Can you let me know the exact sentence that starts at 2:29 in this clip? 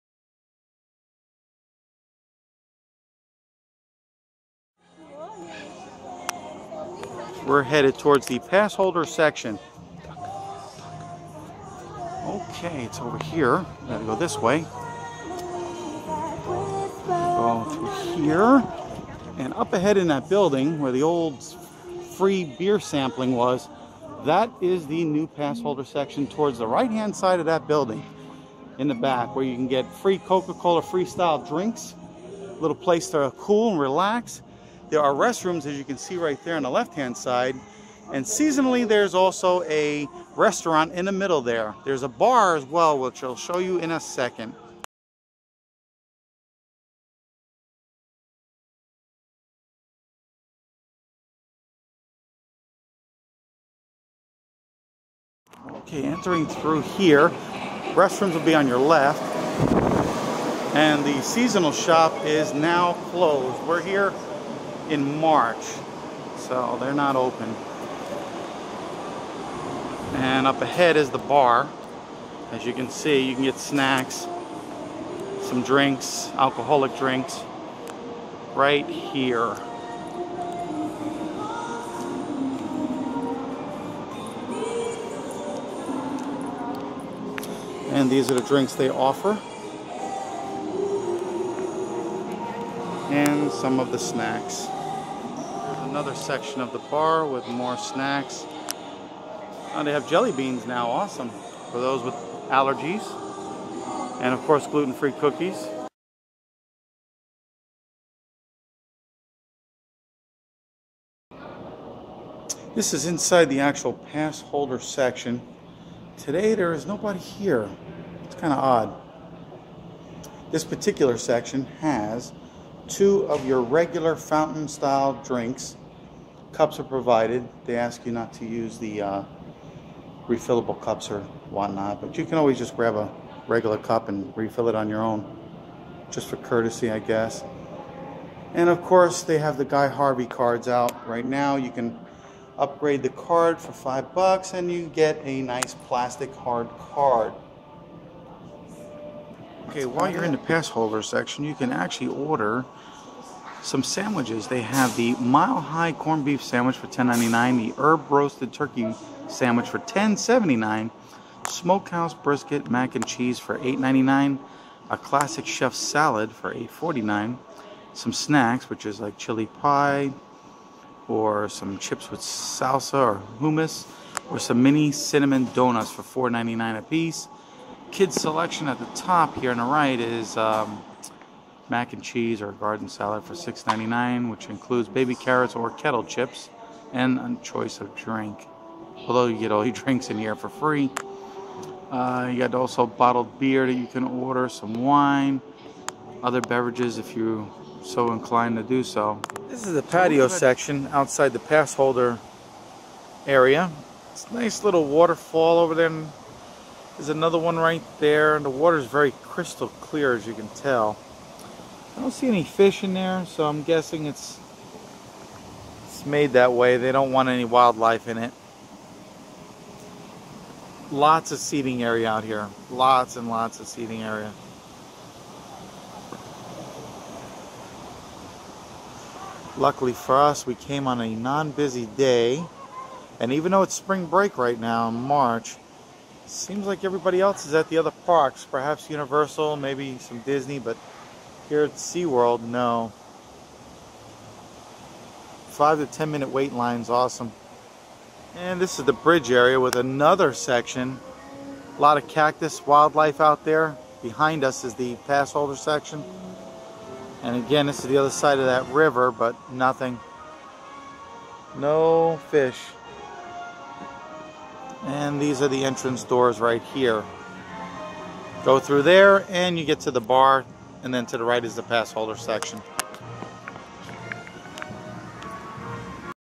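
Okay, while you're in the pass holder section, you can actually order some sandwiches.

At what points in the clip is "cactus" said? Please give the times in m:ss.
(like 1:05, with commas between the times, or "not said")
4:12.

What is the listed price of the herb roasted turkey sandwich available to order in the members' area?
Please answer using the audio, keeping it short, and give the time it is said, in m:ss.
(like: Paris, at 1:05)
$10.79, at 2:39.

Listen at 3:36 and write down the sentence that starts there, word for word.
They don't want any wildlife in it.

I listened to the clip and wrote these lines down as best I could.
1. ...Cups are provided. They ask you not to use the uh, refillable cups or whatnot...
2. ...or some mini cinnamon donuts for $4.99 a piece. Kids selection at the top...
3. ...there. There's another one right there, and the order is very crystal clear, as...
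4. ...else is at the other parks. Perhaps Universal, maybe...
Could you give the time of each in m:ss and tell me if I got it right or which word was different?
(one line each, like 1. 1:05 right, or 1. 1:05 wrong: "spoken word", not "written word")
1. 2:06 right
2. 2:54 right
3. 3:25 wrong: "water", not "order"
4. 3:57 right.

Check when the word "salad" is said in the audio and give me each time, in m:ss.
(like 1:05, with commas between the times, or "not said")
2:45, 3:02.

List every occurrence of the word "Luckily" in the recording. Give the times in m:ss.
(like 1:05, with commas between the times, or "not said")
3:49.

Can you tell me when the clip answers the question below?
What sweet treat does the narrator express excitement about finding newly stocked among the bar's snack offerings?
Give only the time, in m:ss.
1:40.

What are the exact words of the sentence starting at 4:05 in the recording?
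Five to 10 minute wait line's awesome.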